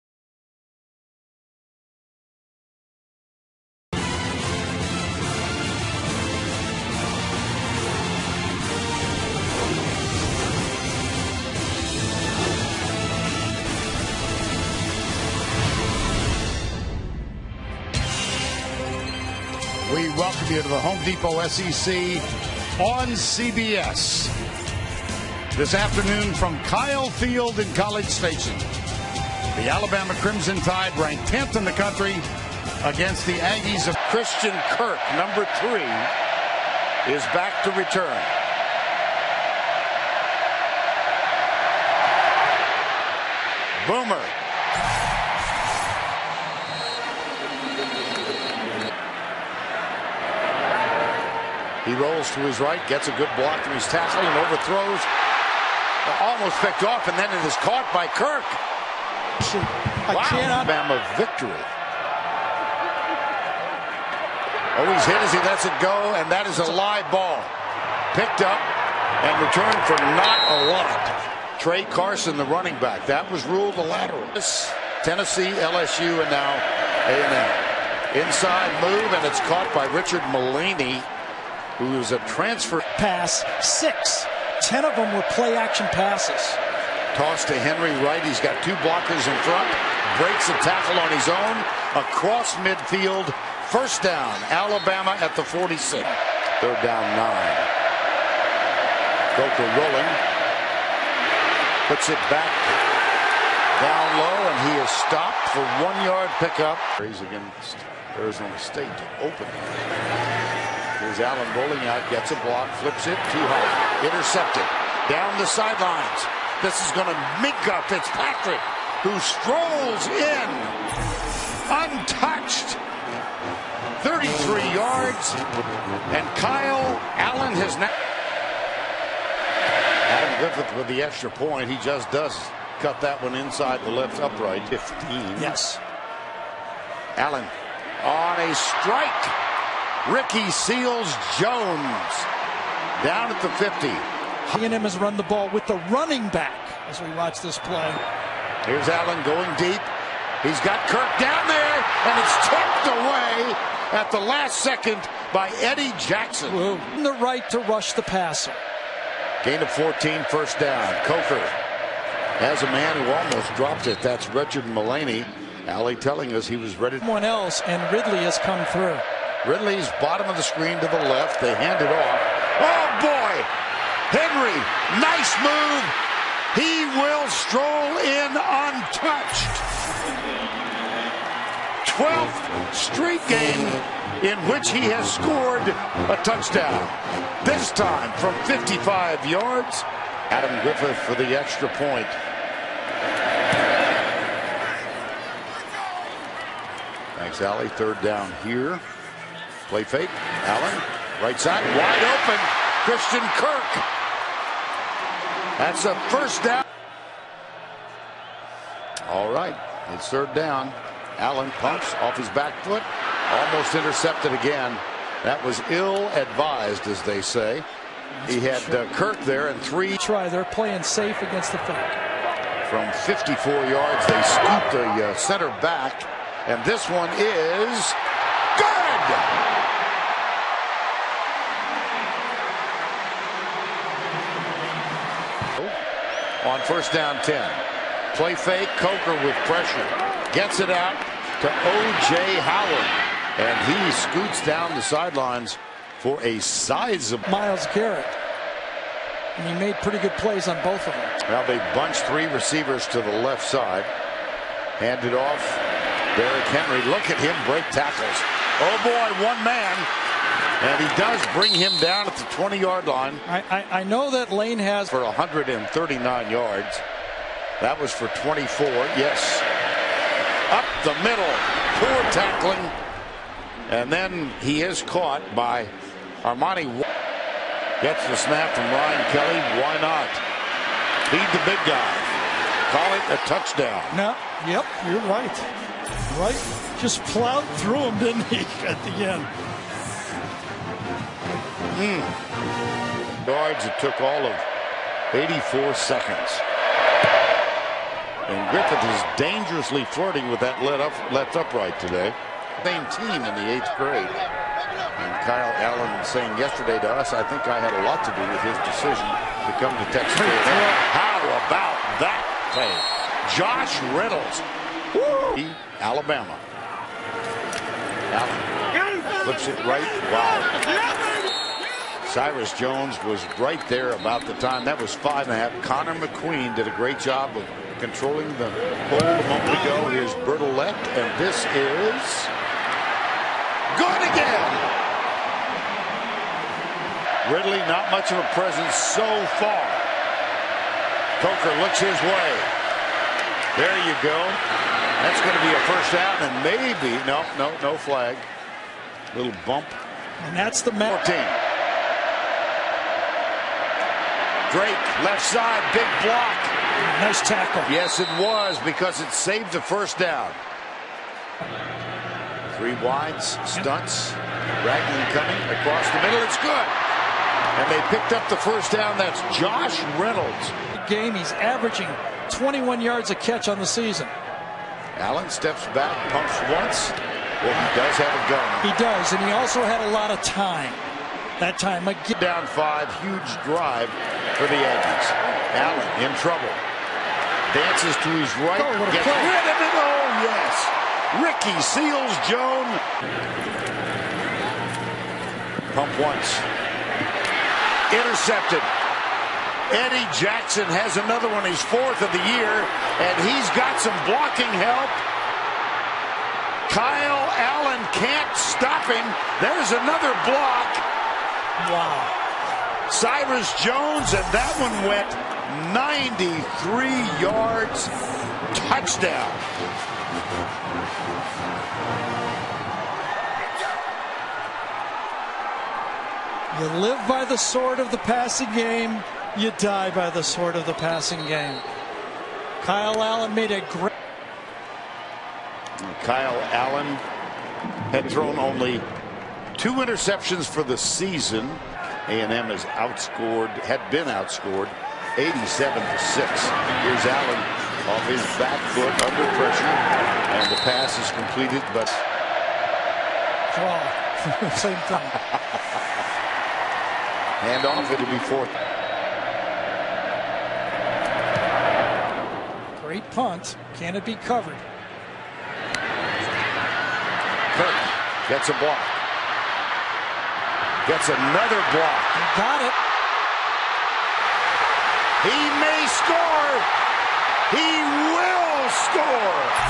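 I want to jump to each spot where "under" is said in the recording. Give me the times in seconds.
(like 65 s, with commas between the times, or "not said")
448 s.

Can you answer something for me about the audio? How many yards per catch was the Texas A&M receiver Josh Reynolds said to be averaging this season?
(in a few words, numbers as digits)
21.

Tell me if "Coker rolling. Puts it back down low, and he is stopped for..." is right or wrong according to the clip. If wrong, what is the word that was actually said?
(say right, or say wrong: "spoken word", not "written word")
right.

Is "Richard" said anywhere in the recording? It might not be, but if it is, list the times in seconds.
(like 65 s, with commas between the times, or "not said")
79 s, 164 s.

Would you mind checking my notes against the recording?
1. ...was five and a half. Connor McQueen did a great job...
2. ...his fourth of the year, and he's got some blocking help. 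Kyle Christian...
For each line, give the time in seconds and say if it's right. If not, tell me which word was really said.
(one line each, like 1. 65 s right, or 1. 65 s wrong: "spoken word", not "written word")
1. 324 s right
2. 401 s wrong: "Allen", not "Christian".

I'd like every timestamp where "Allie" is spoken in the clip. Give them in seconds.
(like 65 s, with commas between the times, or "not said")
165 s, 197 s.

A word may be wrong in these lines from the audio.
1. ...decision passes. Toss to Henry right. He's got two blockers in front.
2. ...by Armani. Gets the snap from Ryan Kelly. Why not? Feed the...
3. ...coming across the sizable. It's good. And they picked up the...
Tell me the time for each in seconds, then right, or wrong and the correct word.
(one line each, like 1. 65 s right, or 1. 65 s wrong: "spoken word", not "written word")
1. 85 s wrong: "action", not "decision"
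2. 275 s right
3. 365 s wrong: "middle", not "sizable".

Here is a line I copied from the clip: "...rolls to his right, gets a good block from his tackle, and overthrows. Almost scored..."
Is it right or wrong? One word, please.
wrong.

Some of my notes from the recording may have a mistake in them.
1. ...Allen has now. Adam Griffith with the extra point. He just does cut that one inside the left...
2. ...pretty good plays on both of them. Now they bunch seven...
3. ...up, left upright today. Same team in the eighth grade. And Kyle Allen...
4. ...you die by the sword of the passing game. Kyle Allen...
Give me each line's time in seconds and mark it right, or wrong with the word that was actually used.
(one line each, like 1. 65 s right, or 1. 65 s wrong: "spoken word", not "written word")
1. 127 s right
2. 249 s wrong: "three", not "seven"
3. 300 s right
4. 429 s right.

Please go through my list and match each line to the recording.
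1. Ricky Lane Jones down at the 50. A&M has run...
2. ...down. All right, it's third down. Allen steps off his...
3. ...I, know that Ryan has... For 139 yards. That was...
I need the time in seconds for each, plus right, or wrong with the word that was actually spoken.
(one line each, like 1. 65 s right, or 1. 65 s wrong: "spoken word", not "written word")
1. 140 s wrong: "Seals", not "Lane"
2. 206 s wrong: "pumps", not "steps"
3. 263 s wrong: "Lane", not "Ryan".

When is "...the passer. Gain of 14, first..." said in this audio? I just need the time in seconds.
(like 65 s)
157 s.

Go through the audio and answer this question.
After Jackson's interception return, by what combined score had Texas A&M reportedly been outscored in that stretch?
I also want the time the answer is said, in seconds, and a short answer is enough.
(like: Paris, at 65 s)
87 to 6, at 445 s.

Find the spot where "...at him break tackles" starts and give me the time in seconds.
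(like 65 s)
257 s.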